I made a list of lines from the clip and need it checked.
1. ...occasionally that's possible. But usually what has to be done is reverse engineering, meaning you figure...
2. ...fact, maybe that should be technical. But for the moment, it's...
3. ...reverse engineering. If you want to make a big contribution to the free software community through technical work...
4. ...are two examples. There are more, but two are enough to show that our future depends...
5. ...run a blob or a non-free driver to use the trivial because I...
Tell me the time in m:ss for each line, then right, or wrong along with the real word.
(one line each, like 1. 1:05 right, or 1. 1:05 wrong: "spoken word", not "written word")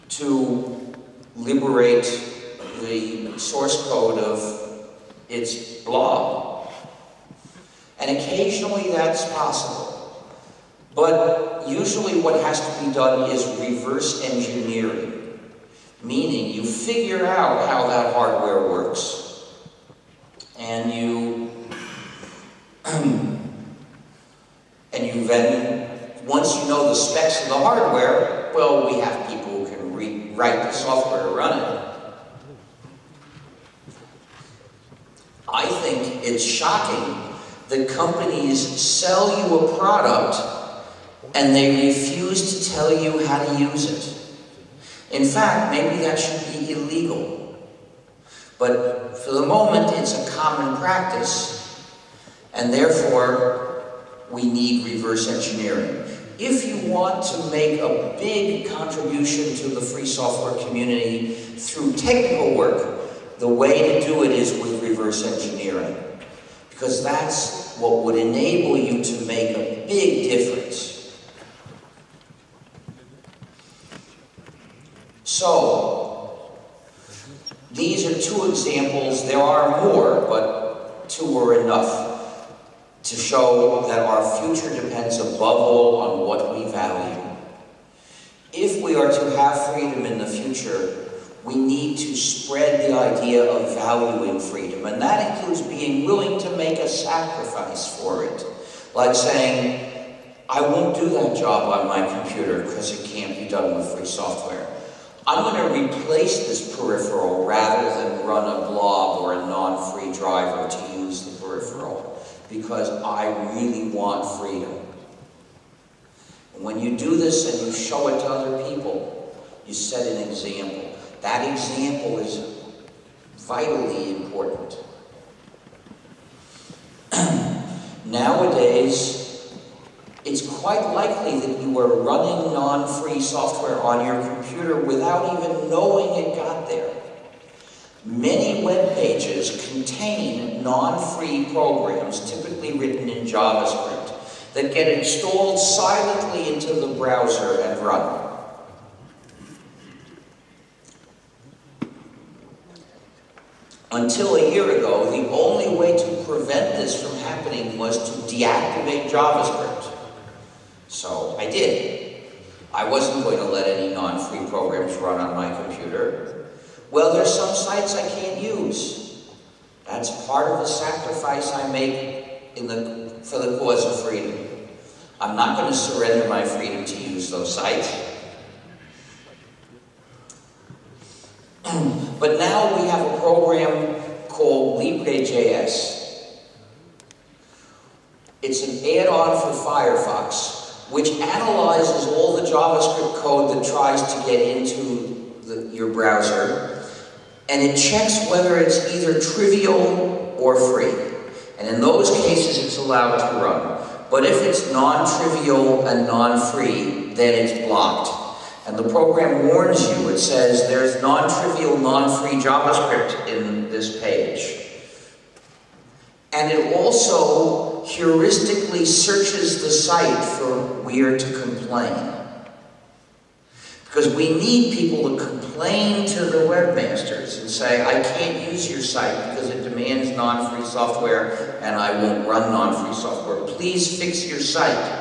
1. 0:08 right
2. 0:45 wrong: "illegal", not "technical"
3. 0:54 right
4. 1:18 right
5. 1:48 wrong: "peripheral", not "trivial".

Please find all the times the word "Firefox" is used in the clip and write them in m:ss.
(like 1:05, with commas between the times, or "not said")
3:09.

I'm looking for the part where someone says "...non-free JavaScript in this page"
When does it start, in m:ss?
3:31.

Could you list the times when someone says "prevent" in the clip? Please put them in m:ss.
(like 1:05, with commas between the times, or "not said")
2:36.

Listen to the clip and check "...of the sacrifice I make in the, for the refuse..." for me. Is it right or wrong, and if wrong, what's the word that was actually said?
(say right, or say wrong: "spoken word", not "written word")
wrong: "cause", not "refuse".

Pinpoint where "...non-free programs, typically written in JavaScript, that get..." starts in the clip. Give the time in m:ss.
2:20.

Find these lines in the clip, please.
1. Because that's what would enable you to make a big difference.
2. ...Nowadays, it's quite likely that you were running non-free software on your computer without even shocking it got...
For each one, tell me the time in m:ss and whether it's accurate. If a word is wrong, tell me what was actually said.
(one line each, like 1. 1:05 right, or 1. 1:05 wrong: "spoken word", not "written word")
1. 1:06 right
2. 2:08 wrong: "knowing", not "shocking".